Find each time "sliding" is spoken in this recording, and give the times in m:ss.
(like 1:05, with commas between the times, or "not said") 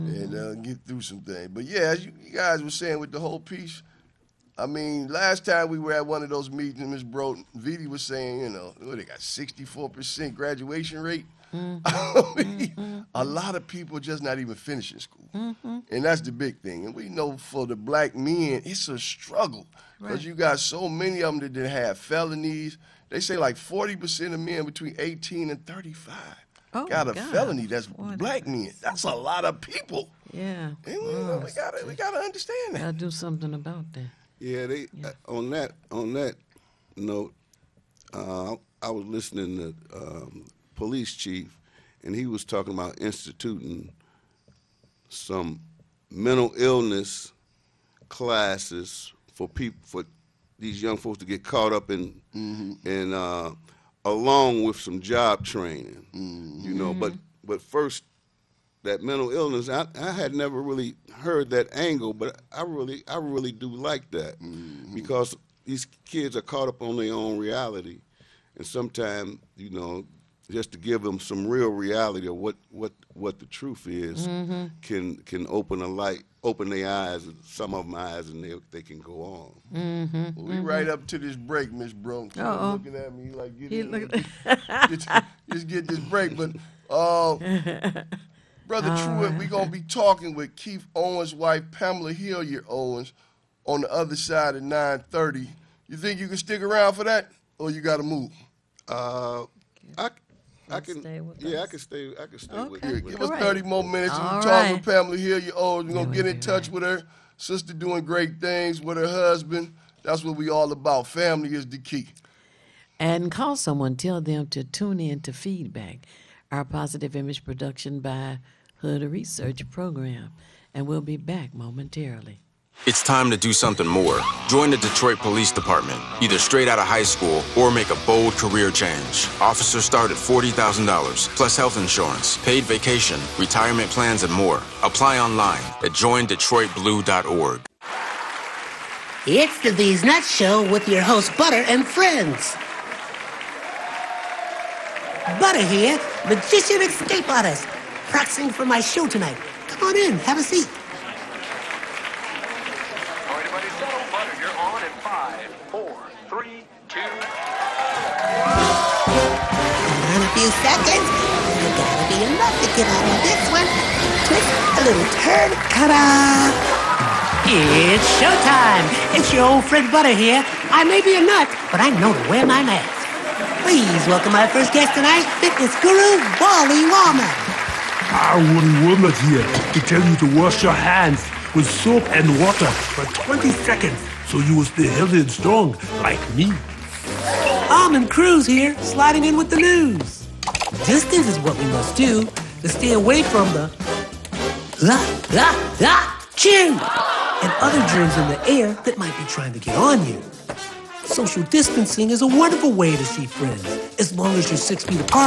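3:08.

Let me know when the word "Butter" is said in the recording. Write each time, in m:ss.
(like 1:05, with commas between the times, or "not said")
2:21, 2:25, 2:49.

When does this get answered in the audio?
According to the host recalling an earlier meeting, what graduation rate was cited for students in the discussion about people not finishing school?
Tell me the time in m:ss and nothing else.
0:09.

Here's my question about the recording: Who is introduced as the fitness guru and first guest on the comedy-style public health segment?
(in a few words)
Wally Wallman.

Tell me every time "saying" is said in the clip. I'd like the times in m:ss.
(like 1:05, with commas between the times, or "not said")
0:02, 0:08.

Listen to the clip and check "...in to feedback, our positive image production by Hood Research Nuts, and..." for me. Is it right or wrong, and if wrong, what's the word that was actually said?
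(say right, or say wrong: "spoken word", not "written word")
wrong: "Program", not "Nuts".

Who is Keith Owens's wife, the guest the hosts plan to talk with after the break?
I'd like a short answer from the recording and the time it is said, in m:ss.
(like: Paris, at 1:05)
Pamela Hillier Owens, at 1:31.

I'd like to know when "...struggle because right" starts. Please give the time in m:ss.
0:18.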